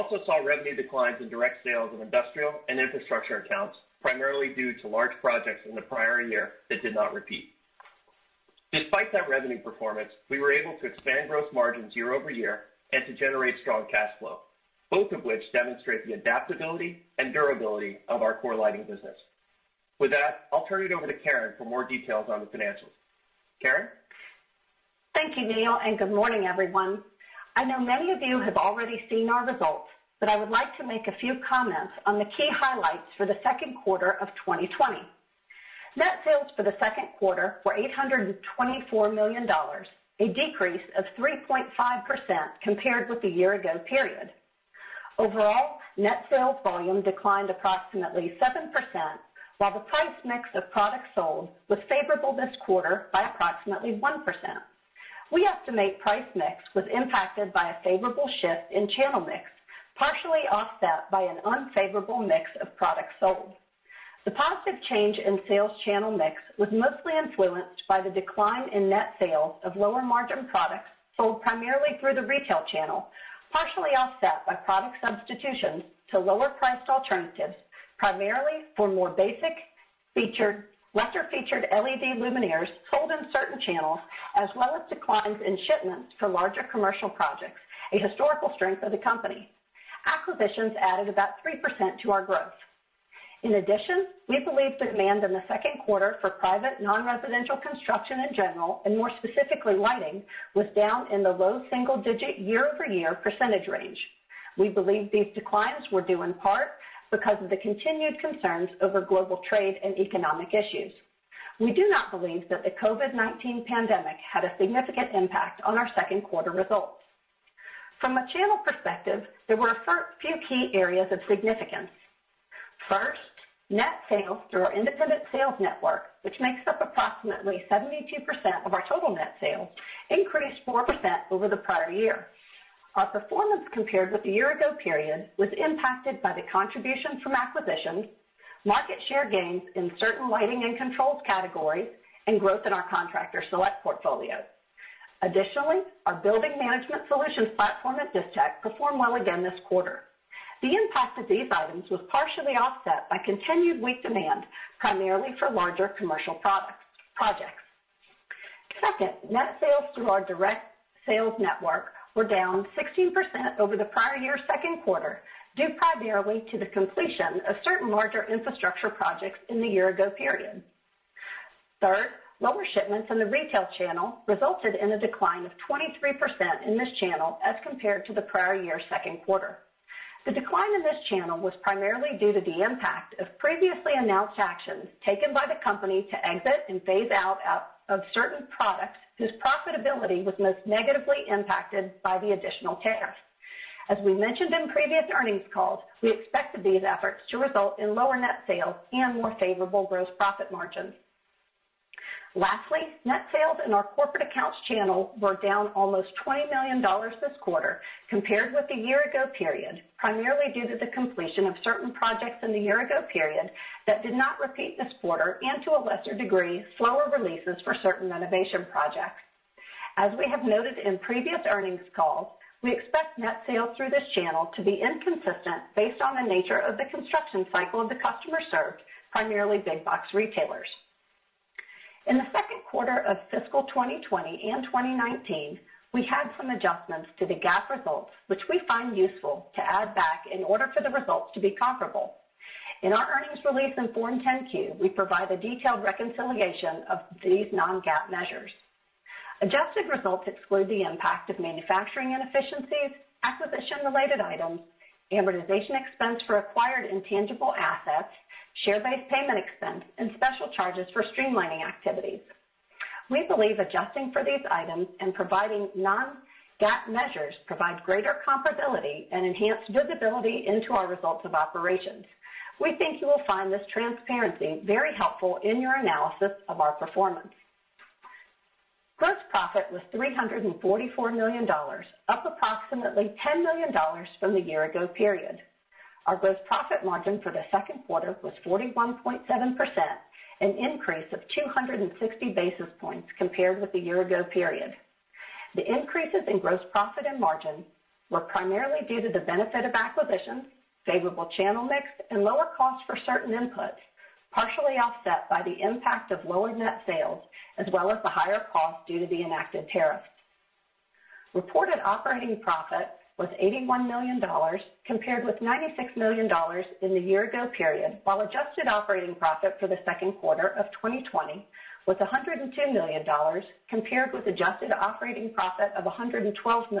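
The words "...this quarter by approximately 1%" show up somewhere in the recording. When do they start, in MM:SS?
00:52.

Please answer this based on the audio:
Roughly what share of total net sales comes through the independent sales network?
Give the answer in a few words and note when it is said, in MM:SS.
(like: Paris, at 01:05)
72%, at 02:07.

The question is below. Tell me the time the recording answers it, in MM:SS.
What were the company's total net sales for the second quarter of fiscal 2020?
00:37.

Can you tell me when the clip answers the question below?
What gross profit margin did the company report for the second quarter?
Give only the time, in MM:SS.
04:48.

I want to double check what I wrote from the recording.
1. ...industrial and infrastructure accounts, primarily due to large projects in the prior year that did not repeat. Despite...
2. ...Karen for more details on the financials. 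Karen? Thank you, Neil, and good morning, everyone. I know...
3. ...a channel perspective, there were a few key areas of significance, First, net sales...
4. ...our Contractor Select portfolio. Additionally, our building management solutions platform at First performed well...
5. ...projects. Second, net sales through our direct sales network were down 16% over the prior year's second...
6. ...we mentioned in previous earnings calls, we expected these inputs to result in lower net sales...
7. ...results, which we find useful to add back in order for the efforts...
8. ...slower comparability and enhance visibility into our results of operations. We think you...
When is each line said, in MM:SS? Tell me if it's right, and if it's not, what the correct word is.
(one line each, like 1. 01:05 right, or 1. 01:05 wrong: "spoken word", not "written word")
1. 00:01 right
2. 00:21 right
3. 01:58 right
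4. 02:22 wrong: "Distech", not "First"
5. 02:37 right
6. 03:14 wrong: "efforts", not "inputs"
7. 03:57 wrong: "results", not "efforts"
8. 04:27 wrong: "greater", not "slower".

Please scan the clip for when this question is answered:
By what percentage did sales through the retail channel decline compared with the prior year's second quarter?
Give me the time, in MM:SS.
02:55.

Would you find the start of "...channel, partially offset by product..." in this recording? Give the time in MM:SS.
01:12.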